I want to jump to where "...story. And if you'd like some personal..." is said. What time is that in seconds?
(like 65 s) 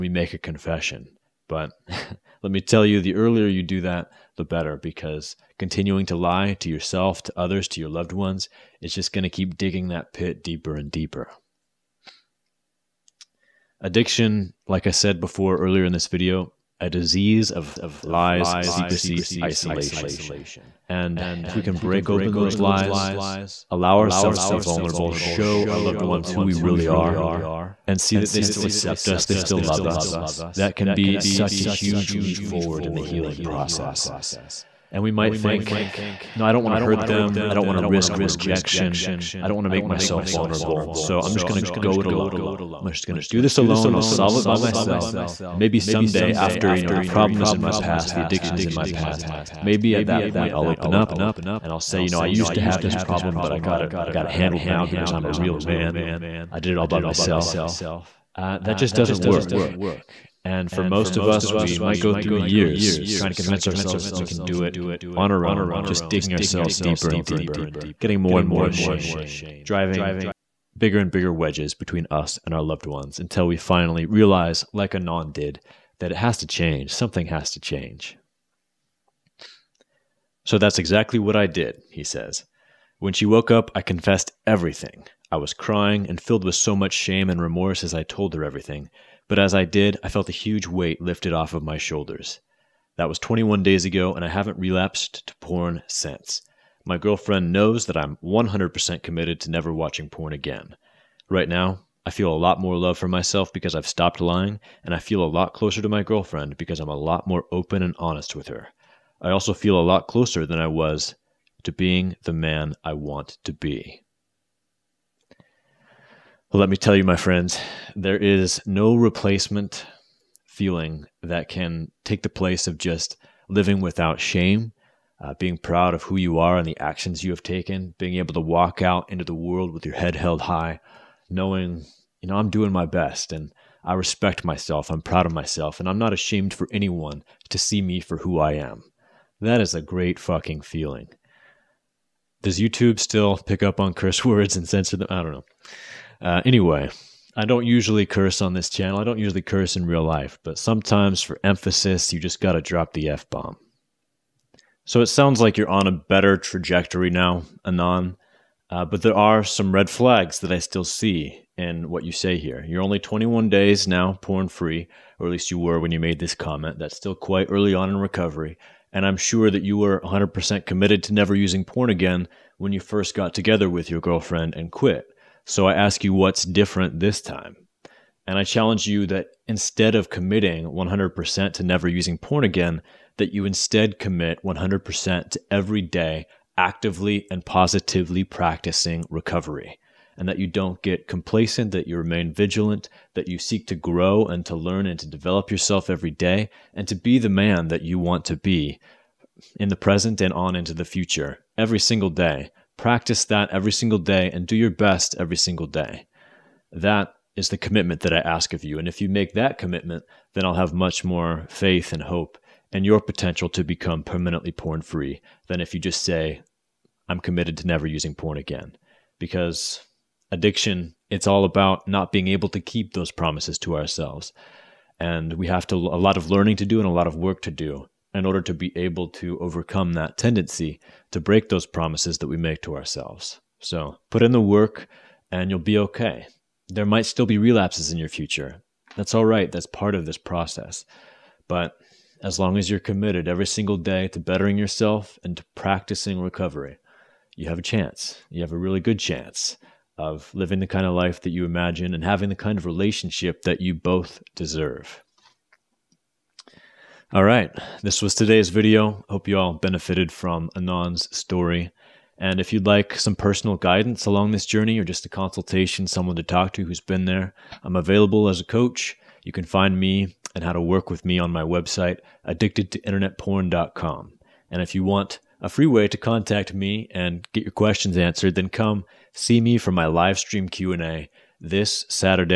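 261 s.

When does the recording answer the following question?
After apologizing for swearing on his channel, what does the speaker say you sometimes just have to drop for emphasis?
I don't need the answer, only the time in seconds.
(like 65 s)
153 s.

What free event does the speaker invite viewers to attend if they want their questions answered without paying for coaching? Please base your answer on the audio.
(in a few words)
live stream Q&A.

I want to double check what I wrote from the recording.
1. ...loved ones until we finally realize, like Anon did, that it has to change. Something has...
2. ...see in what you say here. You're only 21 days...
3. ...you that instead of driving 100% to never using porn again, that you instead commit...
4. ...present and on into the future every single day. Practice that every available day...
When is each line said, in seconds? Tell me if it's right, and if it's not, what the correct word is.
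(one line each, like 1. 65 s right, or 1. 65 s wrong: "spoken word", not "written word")
1. 72 s right
2. 160 s right
3. 178 s wrong: "committing", not "driving"
4. 199 s wrong: "single", not "available".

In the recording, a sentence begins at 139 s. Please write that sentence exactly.
That is a great fucking feeling.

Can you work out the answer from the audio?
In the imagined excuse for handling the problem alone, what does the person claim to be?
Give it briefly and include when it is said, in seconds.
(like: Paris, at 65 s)
a real man, at 55 s.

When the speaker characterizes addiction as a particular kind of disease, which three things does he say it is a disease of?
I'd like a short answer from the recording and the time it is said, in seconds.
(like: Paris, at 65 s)
lies, secrecy, isolation, at 18 s.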